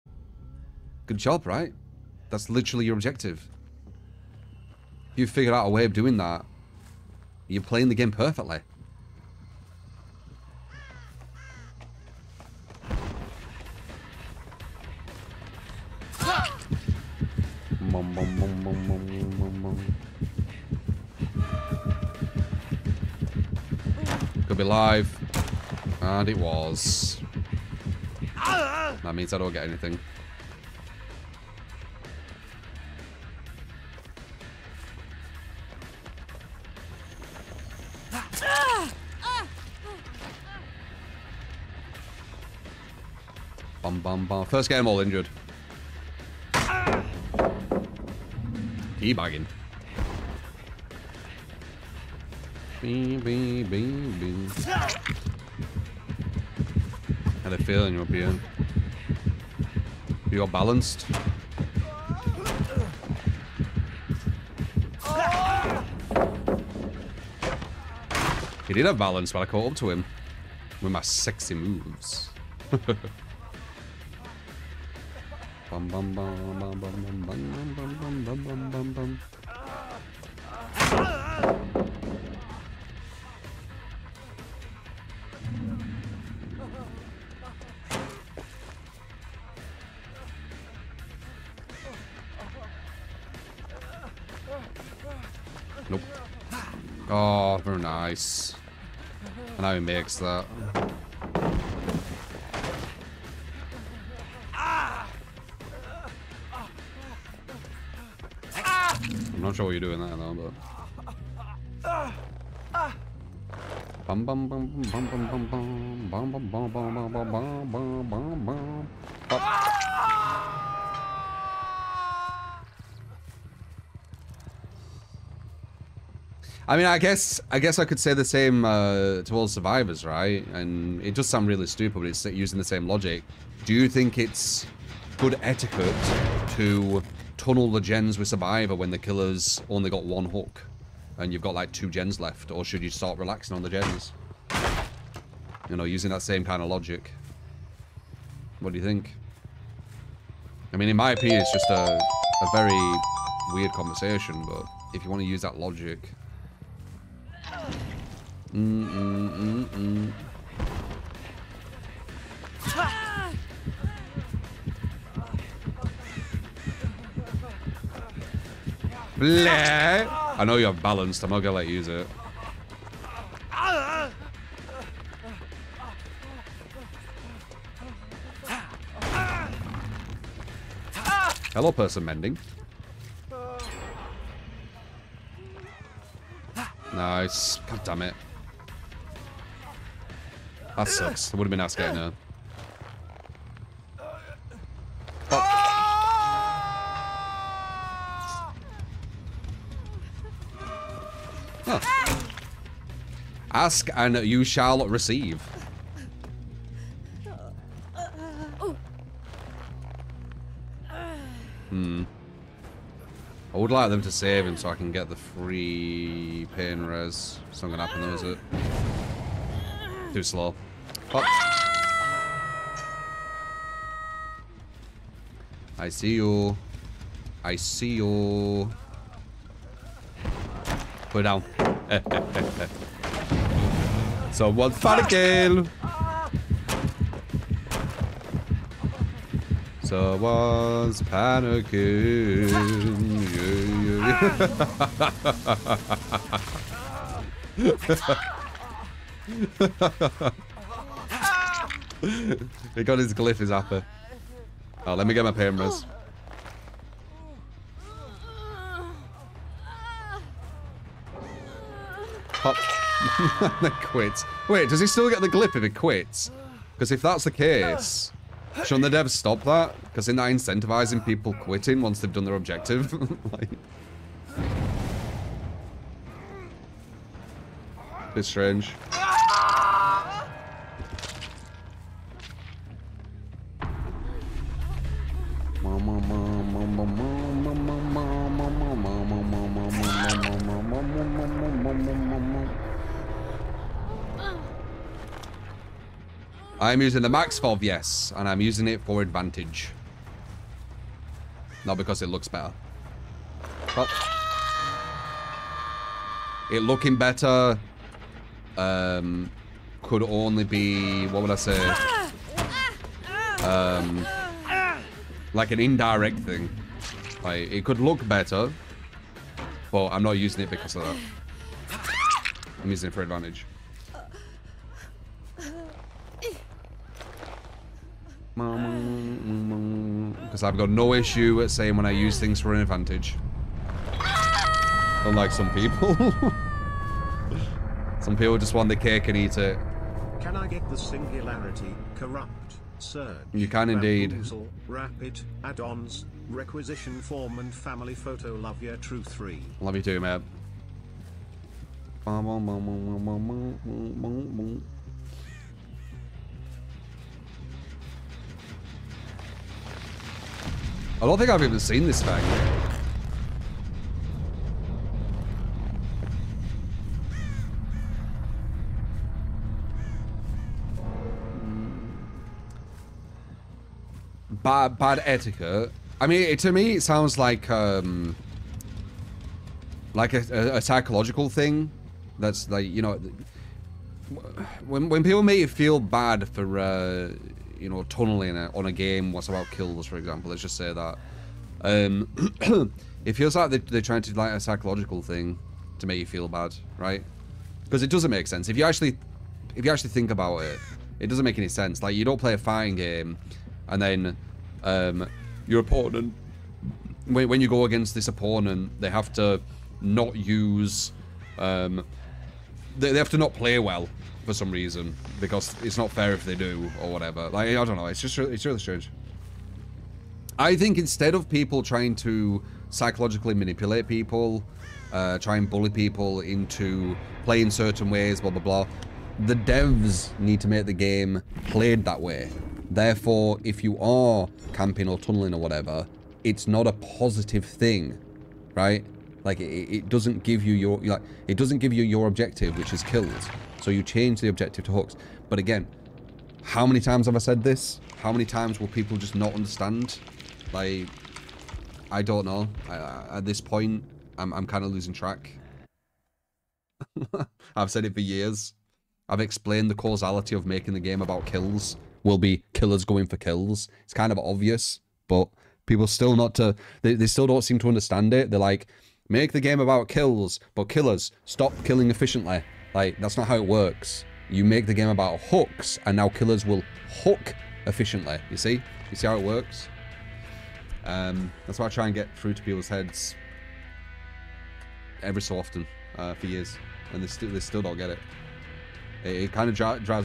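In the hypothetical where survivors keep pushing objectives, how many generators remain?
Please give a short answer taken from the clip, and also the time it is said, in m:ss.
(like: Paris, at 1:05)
2, at 2:21.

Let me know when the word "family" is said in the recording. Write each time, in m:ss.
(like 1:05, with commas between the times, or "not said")
5:47.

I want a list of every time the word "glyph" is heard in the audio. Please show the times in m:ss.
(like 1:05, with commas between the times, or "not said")
4:13, 4:25.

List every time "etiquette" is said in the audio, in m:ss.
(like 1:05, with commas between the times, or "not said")
2:15, 6:15.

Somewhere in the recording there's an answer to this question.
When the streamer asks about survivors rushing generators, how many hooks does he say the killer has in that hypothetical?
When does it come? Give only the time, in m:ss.
2:20.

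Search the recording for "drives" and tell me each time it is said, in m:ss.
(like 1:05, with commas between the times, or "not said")
8:09.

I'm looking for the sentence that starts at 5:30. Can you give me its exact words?
I've got no issue at saying when I use things for an advantage.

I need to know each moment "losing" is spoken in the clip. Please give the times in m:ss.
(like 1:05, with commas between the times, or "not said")
7:34.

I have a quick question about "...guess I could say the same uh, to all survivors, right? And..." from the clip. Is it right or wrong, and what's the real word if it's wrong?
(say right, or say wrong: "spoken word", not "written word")
right.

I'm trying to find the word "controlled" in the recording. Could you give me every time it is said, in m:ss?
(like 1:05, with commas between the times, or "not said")
not said.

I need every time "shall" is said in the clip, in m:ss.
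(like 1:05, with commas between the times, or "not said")
3:24.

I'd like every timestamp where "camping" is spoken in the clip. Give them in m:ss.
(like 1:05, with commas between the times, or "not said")
7:14.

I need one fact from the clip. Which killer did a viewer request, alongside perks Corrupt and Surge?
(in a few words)
Singularity.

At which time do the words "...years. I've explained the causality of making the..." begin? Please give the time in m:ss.
7:37.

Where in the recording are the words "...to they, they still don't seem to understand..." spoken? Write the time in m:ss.
7:46.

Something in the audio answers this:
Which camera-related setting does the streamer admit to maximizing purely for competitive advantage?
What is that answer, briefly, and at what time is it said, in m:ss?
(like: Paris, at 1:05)
Max FOV, at 4:57.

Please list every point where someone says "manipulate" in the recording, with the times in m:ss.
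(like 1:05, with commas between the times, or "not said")
7:03.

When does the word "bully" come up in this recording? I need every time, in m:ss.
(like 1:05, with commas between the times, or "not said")
7:05.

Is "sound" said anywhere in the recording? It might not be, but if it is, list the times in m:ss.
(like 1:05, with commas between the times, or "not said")
2:11, 6:16.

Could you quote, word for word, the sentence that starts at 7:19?
Like it, it doesn't give you your like it doesn't give you your objective, which is kills.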